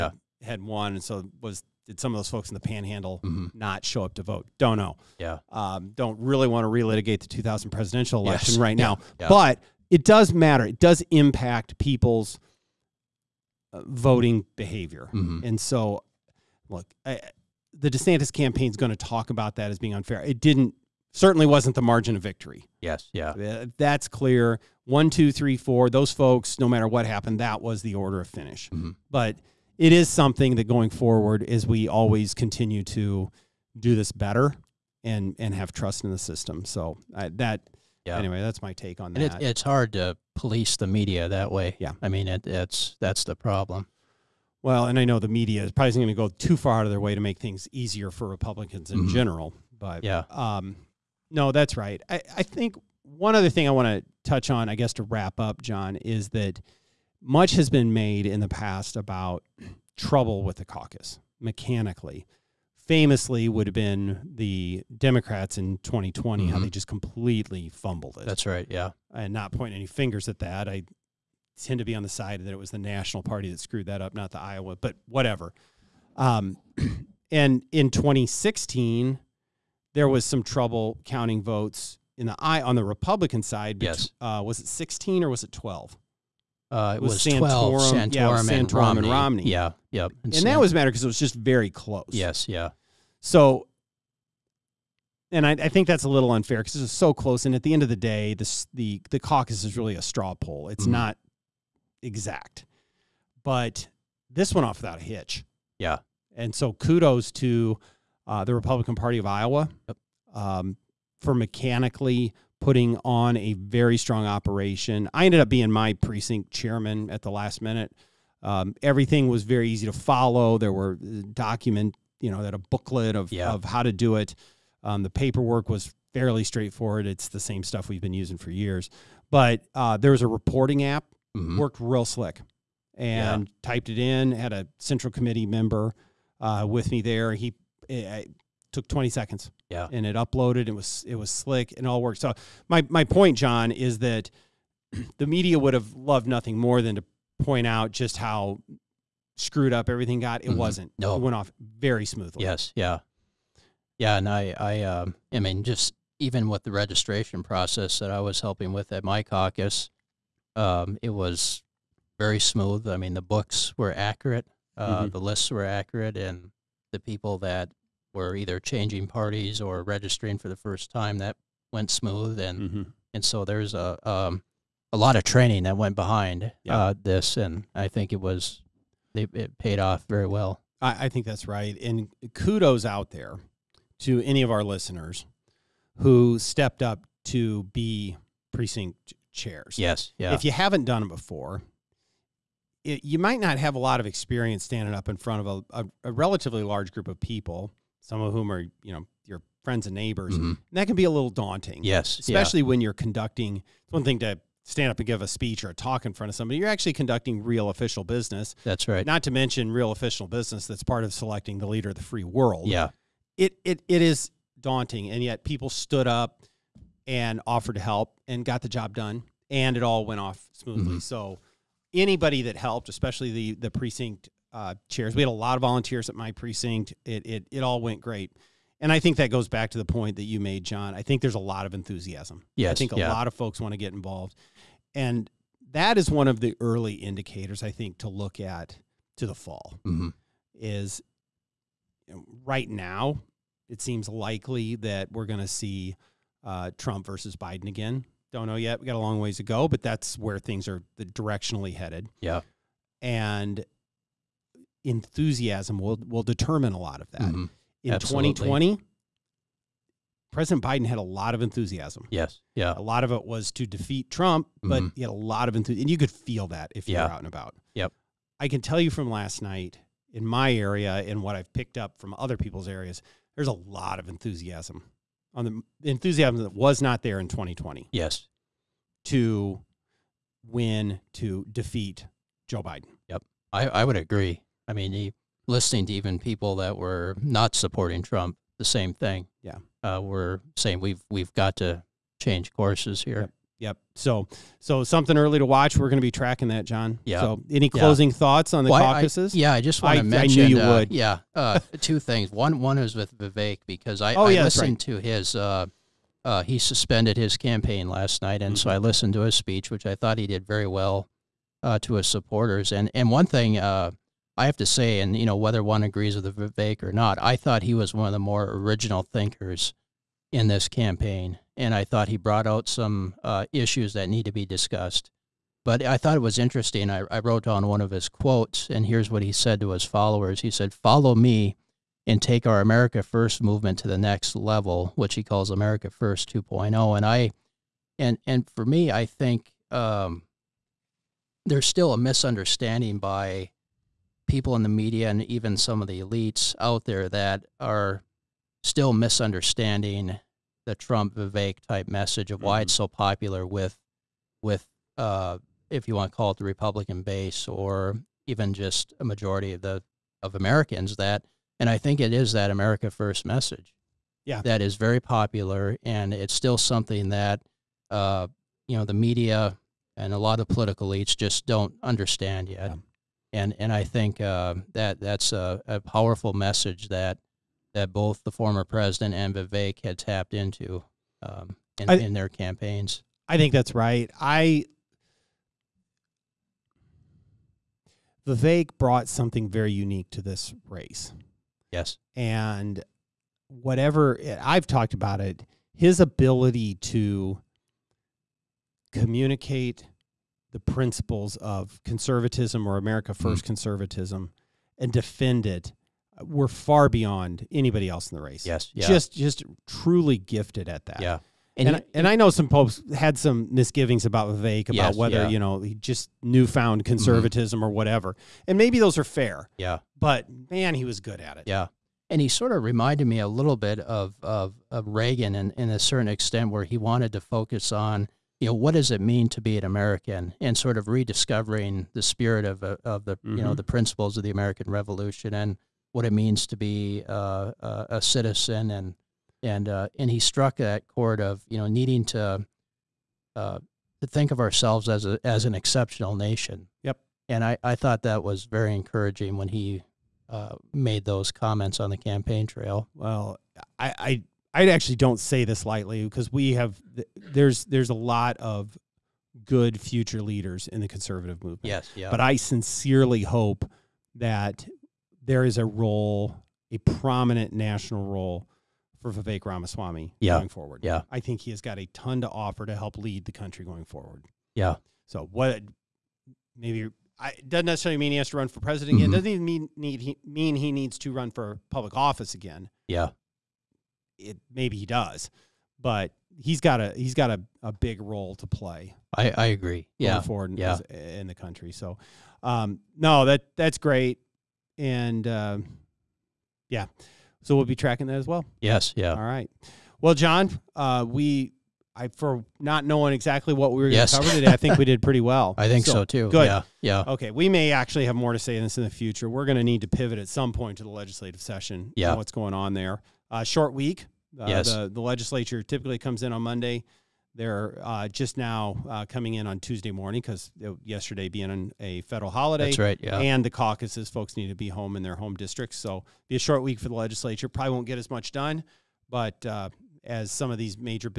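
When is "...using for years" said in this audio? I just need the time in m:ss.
2:08.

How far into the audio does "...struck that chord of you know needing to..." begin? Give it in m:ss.
7:20.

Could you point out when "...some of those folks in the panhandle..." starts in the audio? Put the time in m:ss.
0:01.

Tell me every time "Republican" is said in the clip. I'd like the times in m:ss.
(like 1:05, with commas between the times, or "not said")
0:48, 1:22, 1:48, 5:56.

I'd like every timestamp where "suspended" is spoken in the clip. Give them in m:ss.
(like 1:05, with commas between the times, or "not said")
5:06.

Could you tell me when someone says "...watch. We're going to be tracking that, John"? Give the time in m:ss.
4:55.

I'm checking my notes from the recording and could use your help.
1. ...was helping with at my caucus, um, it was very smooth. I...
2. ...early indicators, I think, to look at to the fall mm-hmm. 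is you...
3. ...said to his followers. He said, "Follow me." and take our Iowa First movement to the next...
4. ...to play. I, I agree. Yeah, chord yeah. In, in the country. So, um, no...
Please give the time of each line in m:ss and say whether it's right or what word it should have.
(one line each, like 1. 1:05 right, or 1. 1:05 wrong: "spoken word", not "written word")
1. 2:38 right
2. 3:56 right
3. 5:29 wrong: "America", not "Iowa"
4. 8:08 wrong: "forward", not "chord".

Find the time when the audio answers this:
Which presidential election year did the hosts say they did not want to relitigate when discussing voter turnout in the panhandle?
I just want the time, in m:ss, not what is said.
0:07.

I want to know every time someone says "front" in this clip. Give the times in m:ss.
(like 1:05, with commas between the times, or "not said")
3:15, 3:26.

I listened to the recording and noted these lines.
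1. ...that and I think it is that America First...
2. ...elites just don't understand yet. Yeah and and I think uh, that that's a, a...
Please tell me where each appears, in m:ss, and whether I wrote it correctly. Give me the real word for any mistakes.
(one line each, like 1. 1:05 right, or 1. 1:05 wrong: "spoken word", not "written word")
1. 6:00 right
2. 6:10 right.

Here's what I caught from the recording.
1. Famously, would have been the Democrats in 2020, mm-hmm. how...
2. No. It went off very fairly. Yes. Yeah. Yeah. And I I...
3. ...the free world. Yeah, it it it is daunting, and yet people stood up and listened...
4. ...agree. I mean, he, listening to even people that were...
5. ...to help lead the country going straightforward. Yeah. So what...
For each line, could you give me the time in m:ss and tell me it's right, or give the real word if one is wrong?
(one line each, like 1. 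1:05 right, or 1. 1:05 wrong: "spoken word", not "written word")
1. 1:02 right
2. 2:30 wrong: "smoothly", not "fairly"
3. 3:31 wrong: "offered", not "listened"
4. 4:43 right
5. 7:52 wrong: "forward", not "straightforward".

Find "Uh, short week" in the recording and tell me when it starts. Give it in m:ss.
8:33.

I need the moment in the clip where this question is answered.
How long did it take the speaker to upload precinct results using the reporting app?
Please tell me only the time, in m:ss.
2:18.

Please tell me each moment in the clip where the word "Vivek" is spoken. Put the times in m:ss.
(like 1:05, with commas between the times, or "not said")
5:03, 5:16, 5:51, 6:19, 6:28, 6:54, 7:49.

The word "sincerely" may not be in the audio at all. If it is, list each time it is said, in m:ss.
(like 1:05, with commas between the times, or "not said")
7:42.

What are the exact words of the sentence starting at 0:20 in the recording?
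It didn't certainly wasn't the margin of victory.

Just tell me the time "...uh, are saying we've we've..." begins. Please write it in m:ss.
4:49.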